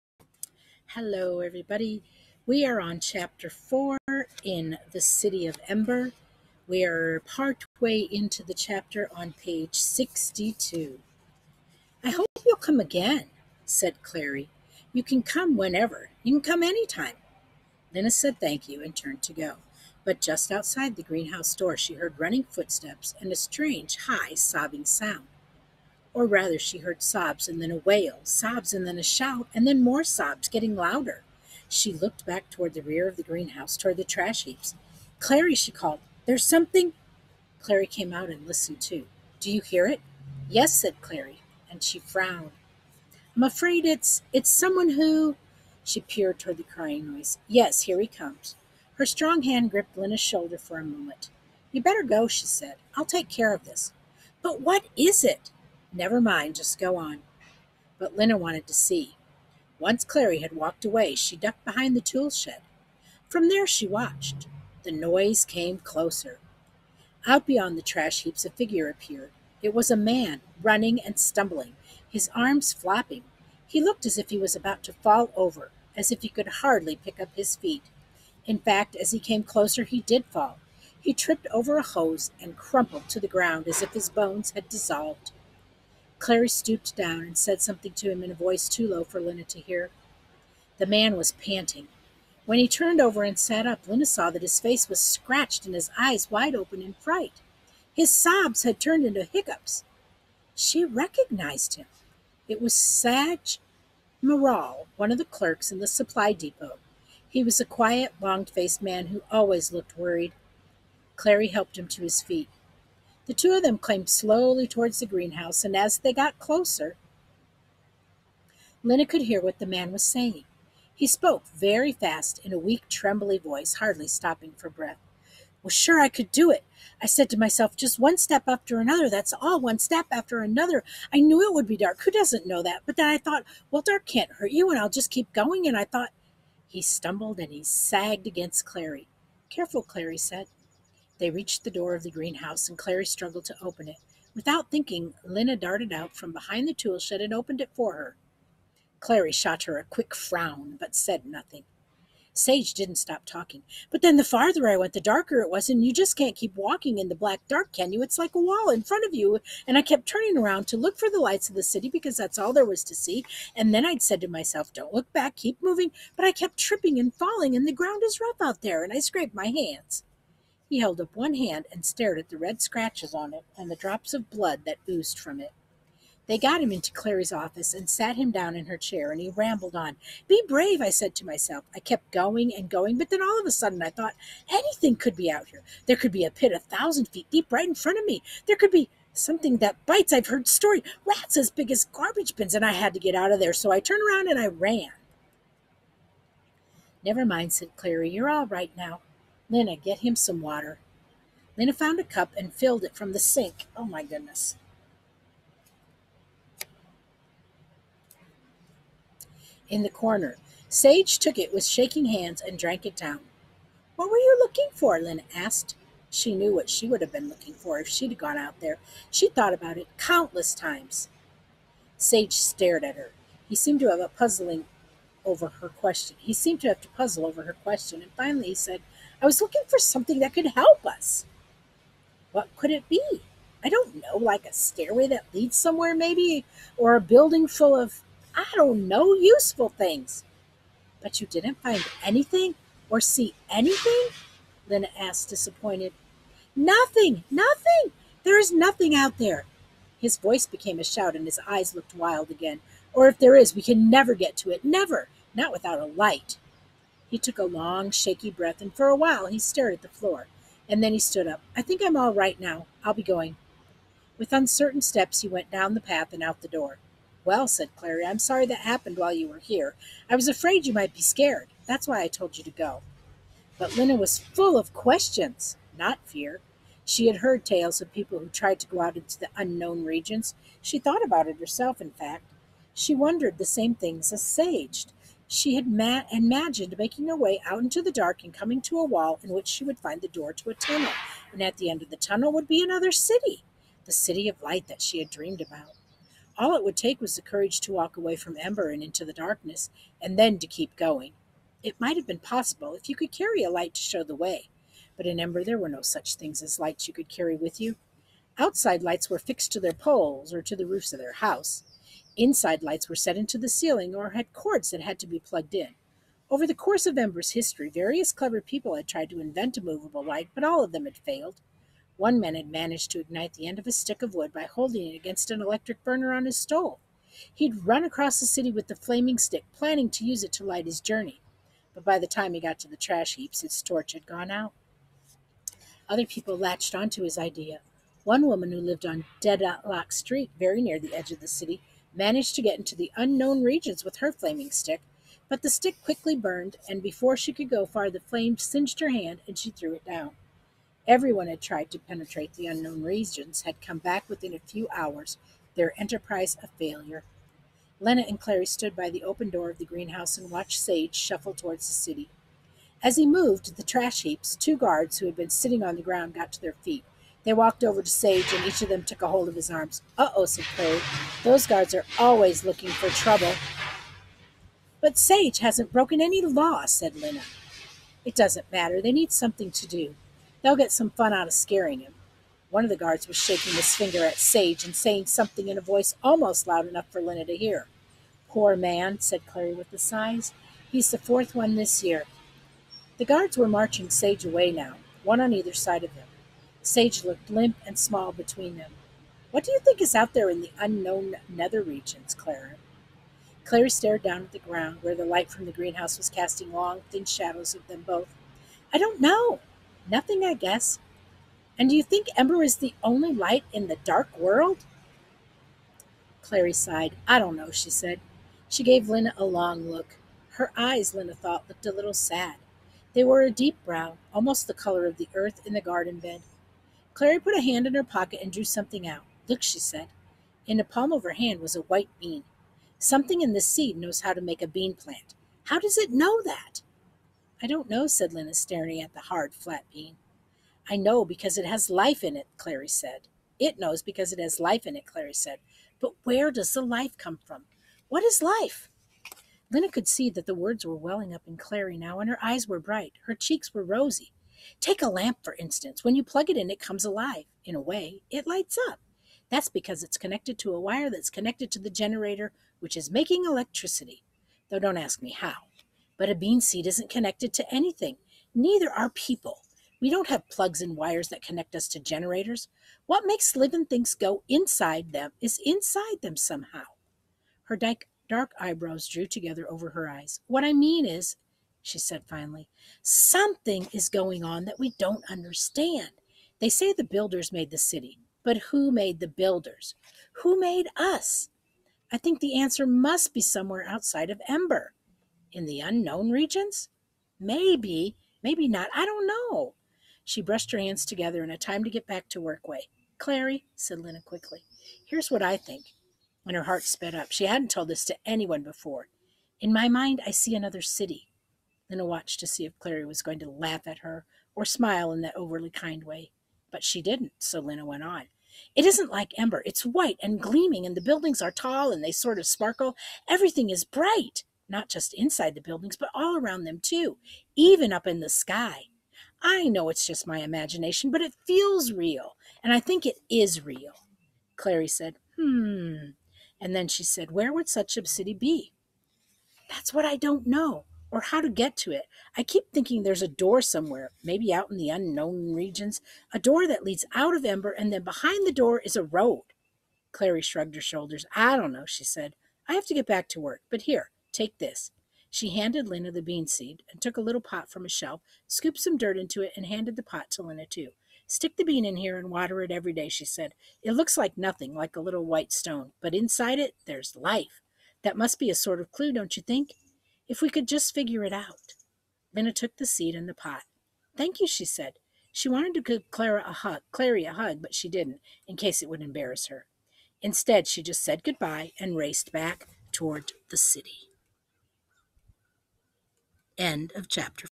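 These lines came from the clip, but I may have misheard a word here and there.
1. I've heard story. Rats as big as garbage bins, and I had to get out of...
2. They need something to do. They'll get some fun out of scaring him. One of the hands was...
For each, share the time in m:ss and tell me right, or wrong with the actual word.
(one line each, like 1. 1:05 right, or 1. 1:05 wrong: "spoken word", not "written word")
1. 3:10 right
2. 6:18 wrong: "guards", not "hands".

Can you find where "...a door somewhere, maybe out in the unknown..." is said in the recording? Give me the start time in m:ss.
9:03.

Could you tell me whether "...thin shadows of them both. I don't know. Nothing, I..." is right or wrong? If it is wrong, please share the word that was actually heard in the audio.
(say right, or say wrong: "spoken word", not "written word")
right.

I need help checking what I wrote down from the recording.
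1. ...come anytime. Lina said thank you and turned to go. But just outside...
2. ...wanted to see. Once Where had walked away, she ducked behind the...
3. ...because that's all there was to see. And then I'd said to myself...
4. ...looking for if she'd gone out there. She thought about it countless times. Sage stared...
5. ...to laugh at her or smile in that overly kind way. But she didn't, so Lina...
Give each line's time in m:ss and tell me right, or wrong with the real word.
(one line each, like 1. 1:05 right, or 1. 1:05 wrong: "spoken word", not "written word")
1. 0:16 right
2. 0:58 wrong: "Clary", not "Where"
3. 2:41 right
4. 3:37 right
5. 8:33 right.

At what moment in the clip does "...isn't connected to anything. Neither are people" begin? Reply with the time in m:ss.
7:46.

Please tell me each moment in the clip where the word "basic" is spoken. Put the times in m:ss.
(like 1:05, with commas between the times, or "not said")
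not said.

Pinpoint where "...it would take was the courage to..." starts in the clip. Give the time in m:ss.
4:56.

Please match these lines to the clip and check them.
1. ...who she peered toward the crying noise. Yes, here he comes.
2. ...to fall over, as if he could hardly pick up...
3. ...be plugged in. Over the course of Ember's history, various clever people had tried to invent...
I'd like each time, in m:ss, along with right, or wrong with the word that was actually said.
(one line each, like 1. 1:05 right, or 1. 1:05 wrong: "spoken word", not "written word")
1. 0:44 right
2. 1:14 right
3. 5:15 right.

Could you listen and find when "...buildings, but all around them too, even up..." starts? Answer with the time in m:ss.
8:45.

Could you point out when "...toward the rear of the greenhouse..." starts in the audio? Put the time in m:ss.
0:32.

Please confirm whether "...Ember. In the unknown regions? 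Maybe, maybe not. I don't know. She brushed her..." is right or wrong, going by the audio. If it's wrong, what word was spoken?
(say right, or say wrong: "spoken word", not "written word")
right.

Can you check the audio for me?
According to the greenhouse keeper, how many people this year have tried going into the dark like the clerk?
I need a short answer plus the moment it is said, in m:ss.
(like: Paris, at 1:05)
4, at 6:30.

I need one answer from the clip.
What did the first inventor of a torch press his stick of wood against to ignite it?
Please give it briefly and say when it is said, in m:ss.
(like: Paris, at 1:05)
electric burner, at 5:25.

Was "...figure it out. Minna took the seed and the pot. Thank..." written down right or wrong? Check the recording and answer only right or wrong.
right.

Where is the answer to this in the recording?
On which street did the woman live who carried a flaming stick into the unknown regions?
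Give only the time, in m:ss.
5:39.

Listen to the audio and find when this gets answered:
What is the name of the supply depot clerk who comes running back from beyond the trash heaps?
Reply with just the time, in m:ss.
1:42.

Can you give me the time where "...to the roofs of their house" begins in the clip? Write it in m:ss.
5:10.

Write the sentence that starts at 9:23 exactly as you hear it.
It looks like nothing, like a little white stone, but inside it, there's life.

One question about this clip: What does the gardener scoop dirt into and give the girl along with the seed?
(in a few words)
little pot.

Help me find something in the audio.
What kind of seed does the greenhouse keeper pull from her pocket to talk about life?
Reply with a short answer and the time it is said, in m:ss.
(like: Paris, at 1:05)
white bean, at 7:11.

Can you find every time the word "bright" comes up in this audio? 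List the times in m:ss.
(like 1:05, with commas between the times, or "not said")
7:32, 8:43.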